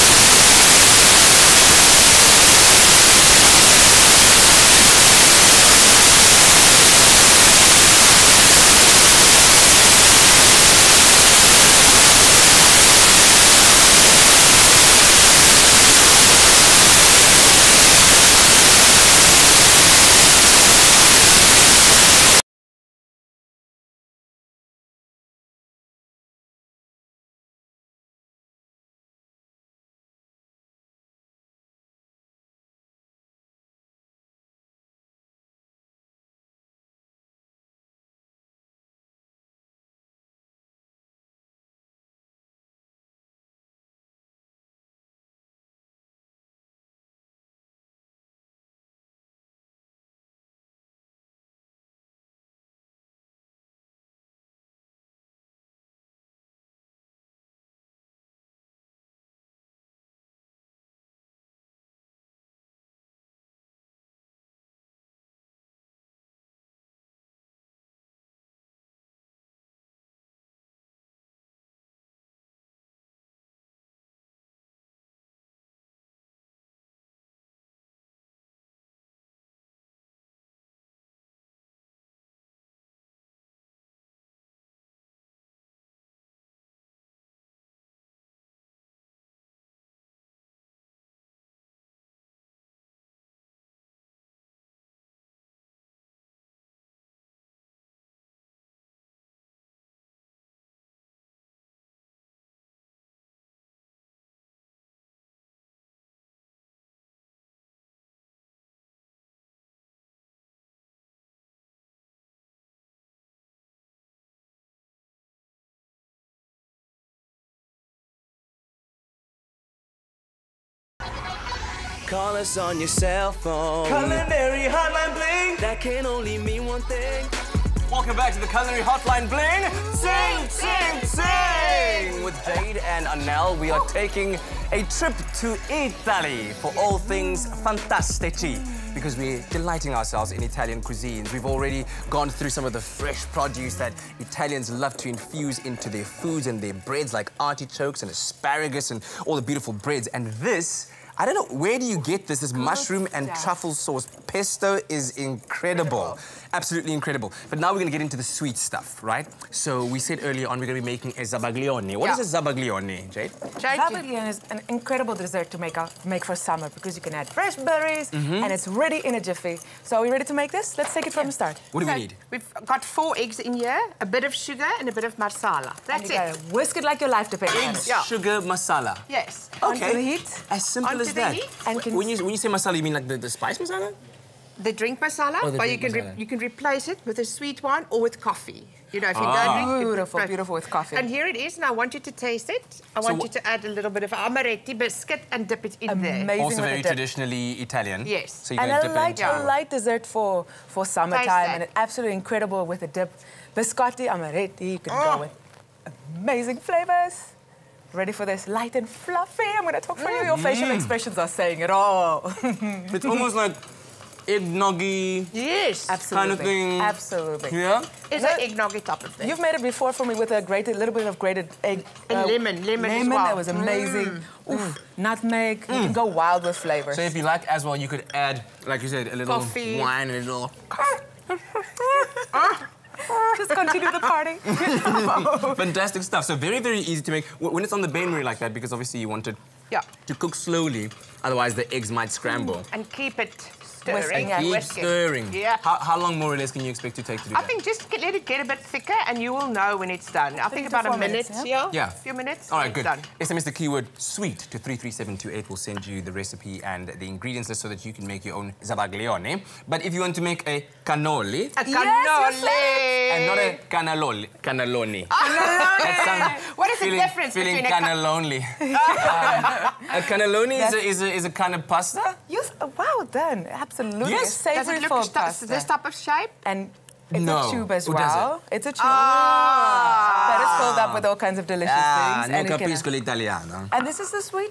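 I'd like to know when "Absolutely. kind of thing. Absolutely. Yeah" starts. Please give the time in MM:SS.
03:35.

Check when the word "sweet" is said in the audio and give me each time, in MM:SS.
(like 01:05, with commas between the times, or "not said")
02:38, 03:07, 04:13.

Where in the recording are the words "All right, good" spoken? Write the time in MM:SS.
04:12.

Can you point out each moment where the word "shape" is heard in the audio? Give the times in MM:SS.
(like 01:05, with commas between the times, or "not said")
04:35.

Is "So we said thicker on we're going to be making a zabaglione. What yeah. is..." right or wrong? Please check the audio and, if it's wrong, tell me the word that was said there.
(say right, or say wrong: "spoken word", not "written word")
wrong: "earlier", not "thicker".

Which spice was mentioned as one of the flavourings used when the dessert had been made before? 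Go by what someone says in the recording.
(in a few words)
nutmeg.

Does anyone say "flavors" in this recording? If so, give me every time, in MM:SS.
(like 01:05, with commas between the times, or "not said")
03:26, 03:46.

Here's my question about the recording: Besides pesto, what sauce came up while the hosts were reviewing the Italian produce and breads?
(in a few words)
mushroom and truffle sauce.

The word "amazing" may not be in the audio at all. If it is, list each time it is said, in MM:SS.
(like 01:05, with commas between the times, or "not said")
03:15, 03:26, 03:43.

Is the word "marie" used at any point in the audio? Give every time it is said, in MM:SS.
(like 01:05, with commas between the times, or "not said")
03:58.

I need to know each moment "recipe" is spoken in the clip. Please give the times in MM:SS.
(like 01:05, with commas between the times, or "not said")
04:16.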